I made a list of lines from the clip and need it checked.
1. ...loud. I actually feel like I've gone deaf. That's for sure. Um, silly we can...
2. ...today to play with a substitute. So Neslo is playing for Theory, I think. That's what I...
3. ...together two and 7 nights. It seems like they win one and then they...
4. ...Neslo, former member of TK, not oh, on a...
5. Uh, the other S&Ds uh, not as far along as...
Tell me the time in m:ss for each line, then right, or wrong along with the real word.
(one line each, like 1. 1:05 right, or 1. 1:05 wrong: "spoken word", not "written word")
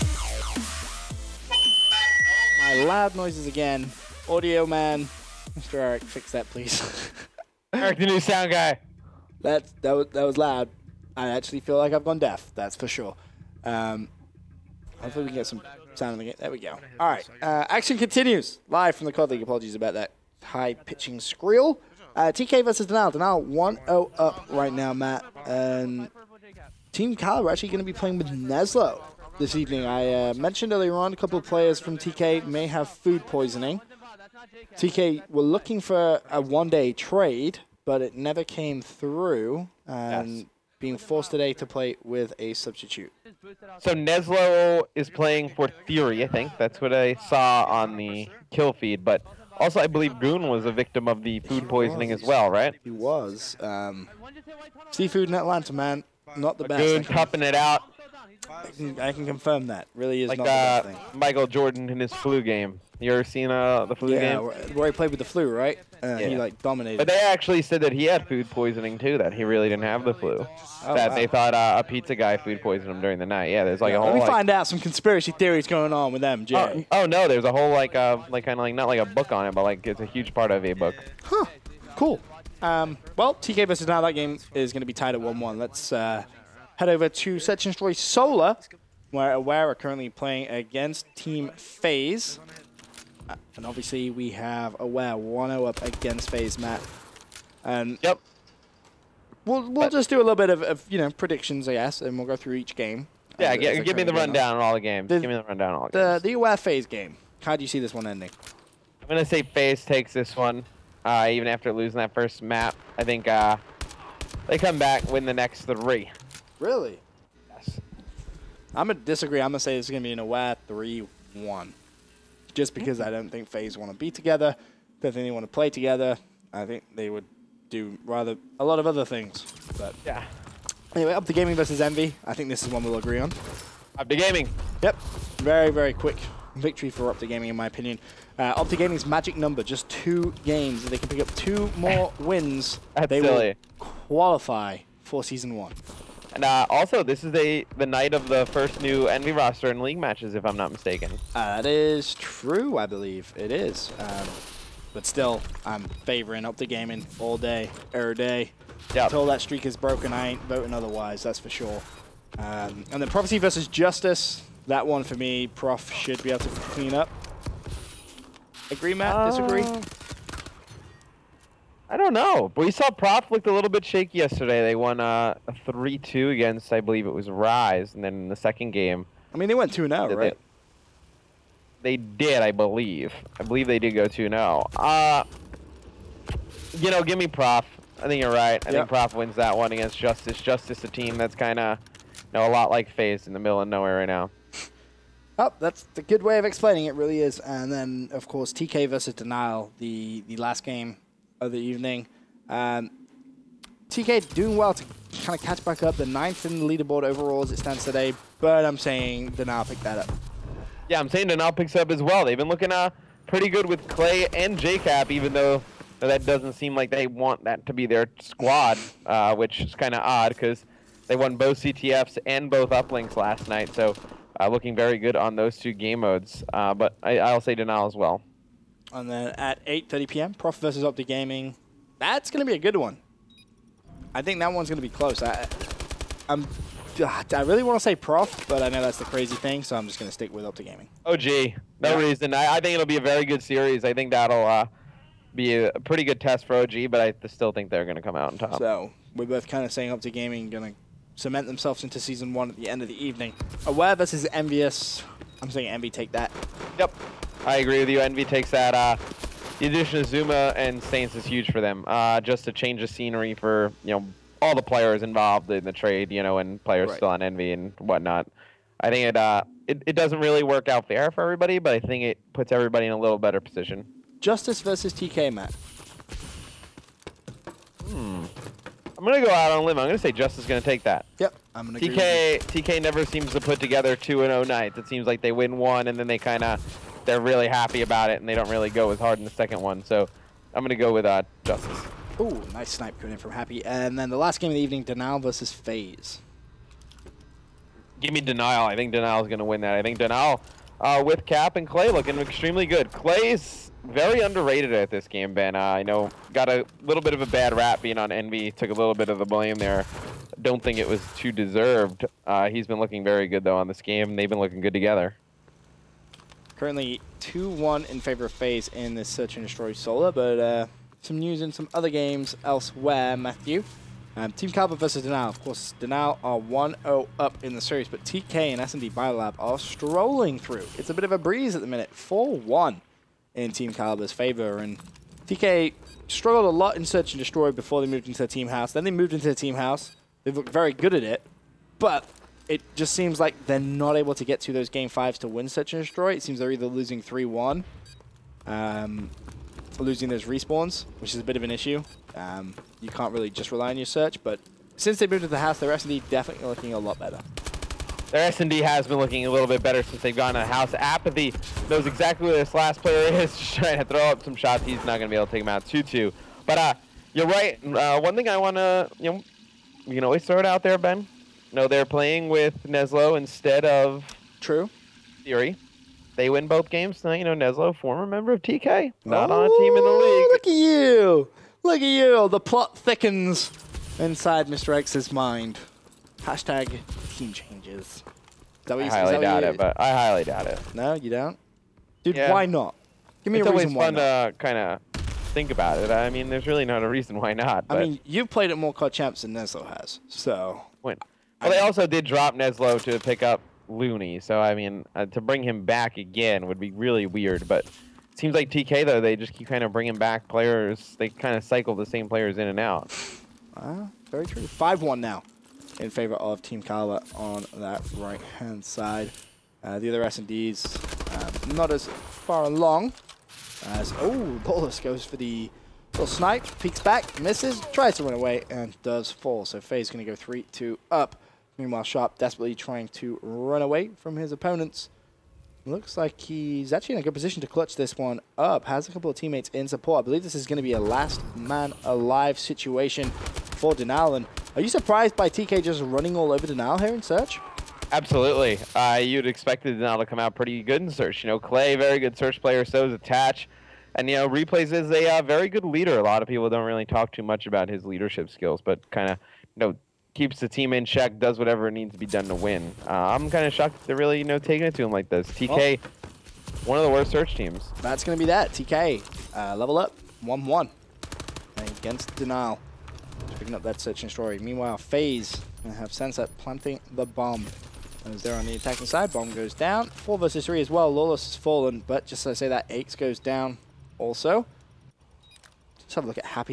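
1. 0:10 wrong: "hopefully", not "silly"
2. 0:41 right
3. 4:43 wrong: "0", not "7"
4. 6:17 right
5. 6:59 right.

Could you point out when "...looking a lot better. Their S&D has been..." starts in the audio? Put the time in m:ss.
5:56.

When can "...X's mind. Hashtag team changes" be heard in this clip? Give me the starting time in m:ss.
6:24.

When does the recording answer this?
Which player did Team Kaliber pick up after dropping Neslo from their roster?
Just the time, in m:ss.
6:43.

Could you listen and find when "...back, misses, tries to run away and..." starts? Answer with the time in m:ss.
7:06.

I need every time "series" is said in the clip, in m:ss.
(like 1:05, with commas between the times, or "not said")
4:03, 5:27.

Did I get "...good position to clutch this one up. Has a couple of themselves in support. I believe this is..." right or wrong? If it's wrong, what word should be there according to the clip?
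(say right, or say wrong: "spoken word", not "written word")
wrong: "teammates", not "themselves".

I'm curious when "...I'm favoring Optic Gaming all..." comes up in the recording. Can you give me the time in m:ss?
2:35.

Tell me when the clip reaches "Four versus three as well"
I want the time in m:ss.
7:59.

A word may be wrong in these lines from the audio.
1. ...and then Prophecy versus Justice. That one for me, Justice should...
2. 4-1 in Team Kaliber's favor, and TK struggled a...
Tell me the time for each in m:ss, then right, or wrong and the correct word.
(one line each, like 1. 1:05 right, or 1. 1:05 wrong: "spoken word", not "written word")
1. 2:42 wrong: "Prof", not "Justice"
2. 5:31 right.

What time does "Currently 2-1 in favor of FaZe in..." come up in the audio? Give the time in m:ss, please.
5:16.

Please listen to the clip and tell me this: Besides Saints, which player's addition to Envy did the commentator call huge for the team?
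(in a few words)
Zuma.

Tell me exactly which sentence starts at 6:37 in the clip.
I mean, you've played it more Clutch Champs than Neslo has, so...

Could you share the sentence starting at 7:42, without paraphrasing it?
Uh, I'm kind of shocked they're really, you know, taking it to him like this.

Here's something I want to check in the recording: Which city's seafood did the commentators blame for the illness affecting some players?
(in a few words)
Atlanta.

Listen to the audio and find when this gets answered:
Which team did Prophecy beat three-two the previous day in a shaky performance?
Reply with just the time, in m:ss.
2:57.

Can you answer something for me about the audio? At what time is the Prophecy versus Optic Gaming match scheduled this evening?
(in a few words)
8.30 p.m.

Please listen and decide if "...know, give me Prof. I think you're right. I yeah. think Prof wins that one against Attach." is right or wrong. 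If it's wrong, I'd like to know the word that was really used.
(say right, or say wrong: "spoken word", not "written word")
wrong: "Justice", not "Attach".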